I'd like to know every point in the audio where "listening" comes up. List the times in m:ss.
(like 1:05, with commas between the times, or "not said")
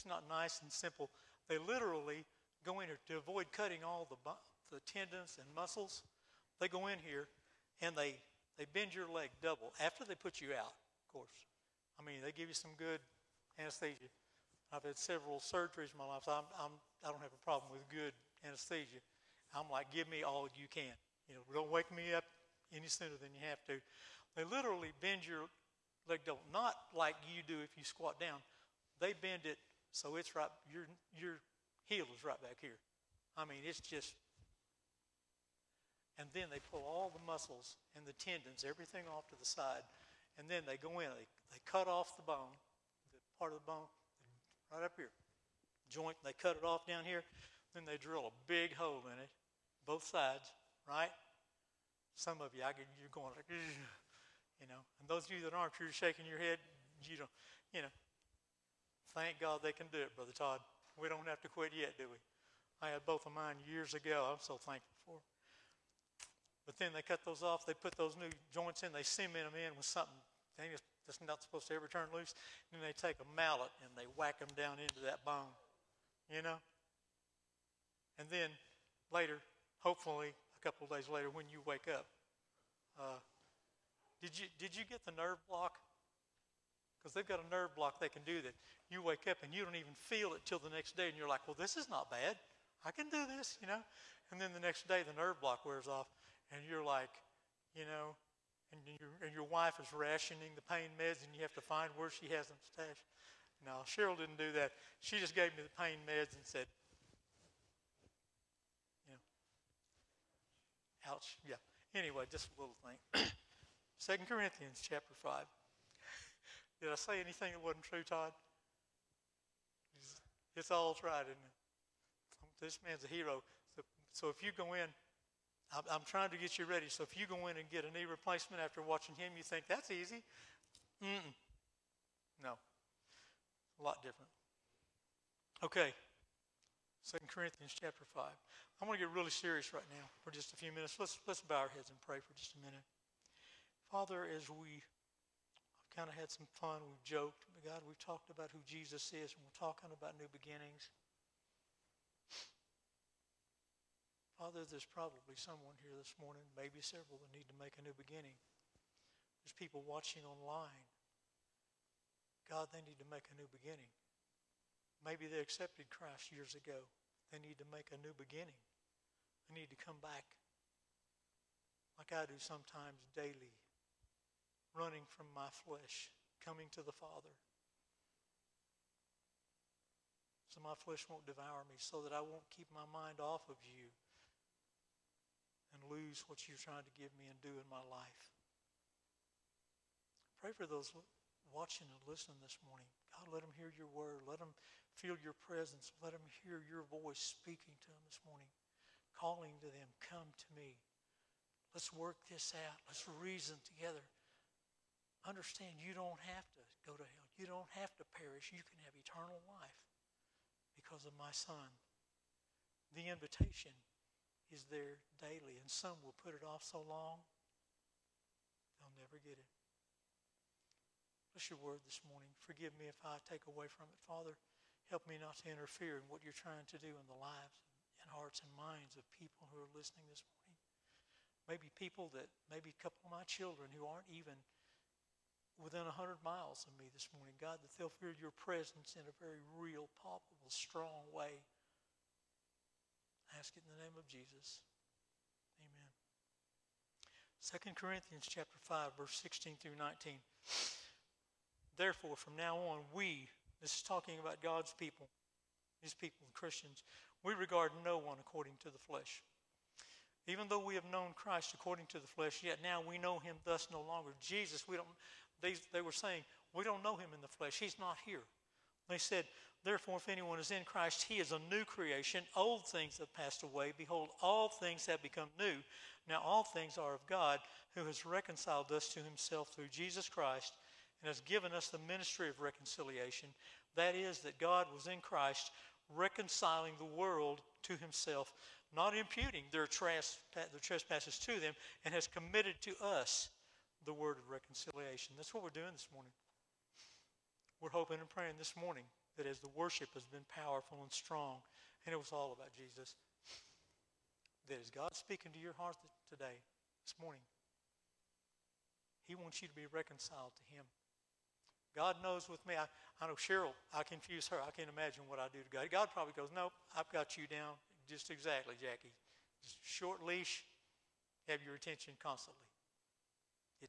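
3:12, 3:49.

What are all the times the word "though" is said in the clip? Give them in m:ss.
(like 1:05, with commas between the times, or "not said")
4:20.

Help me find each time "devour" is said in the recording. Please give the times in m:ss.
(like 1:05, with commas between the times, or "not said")
3:01.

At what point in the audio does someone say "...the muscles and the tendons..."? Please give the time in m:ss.
0:37.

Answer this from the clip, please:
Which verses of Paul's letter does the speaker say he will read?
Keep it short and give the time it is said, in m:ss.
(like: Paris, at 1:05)
16 through 19, at 4:09.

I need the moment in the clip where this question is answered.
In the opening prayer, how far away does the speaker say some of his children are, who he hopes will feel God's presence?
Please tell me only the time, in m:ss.
3:55.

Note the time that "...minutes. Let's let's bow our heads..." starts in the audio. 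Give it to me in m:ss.
2:20.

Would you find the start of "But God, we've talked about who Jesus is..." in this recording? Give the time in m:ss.
2:27.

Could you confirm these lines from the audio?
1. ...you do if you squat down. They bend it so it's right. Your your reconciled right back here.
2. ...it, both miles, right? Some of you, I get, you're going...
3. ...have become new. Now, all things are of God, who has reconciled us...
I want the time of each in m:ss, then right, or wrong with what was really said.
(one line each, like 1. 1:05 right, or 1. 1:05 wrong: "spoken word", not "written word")
1. 0:27 wrong: "healed", not "reconciled"
2. 0:49 wrong: "sides", not "miles"
3. 4:34 right.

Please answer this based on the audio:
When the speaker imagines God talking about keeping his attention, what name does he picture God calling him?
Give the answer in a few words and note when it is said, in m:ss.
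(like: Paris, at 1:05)
Jackie, at 5:18.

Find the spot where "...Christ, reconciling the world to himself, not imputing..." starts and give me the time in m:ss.
4:45.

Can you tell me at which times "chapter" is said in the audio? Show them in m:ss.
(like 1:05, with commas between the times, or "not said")
1:54, 2:17, 4:08.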